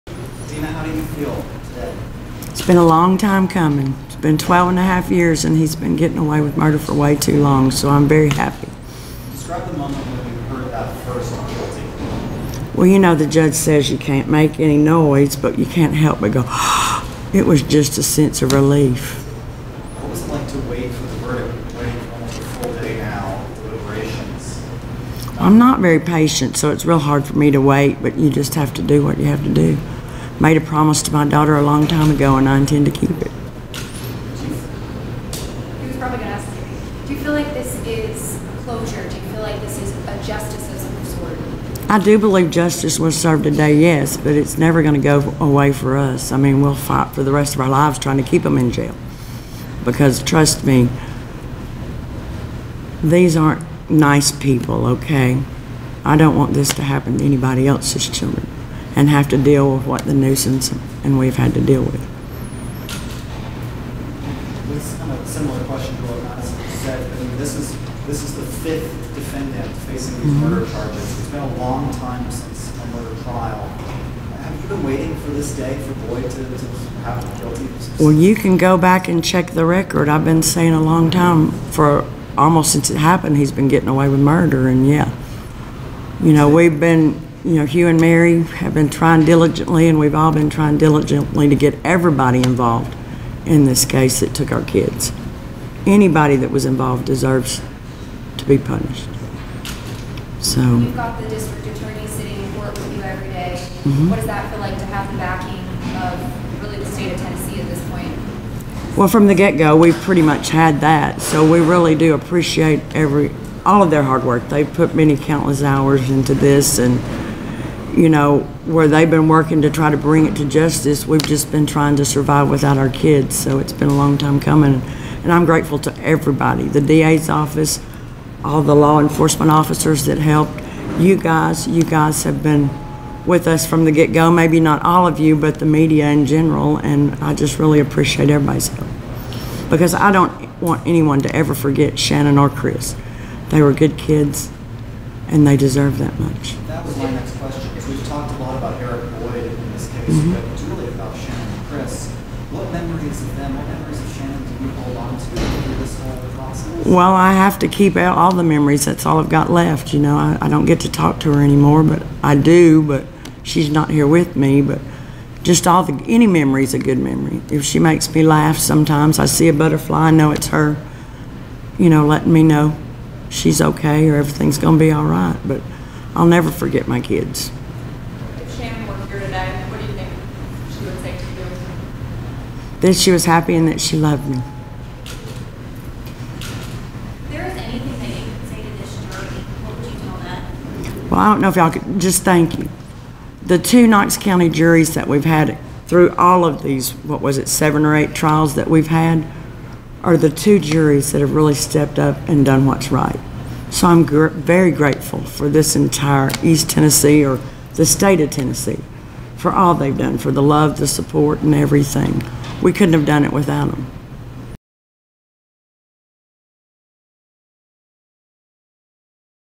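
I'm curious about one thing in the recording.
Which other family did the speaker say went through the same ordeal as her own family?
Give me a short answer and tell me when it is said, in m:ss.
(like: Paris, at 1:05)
The Newsoms, at 1:00.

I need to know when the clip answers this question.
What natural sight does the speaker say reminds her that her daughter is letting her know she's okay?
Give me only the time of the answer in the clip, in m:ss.
2:49.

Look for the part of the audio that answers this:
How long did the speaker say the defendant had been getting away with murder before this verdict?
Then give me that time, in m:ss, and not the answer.
0:04.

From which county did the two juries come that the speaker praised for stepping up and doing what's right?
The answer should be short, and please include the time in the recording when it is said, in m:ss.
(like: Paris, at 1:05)
Knox County, at 3:13.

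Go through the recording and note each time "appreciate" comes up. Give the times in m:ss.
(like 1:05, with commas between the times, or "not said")
1:52, 2:17.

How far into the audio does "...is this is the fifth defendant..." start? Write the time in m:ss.
1:07.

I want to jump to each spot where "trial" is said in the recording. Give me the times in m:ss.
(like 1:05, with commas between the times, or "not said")
1:13, 3:18.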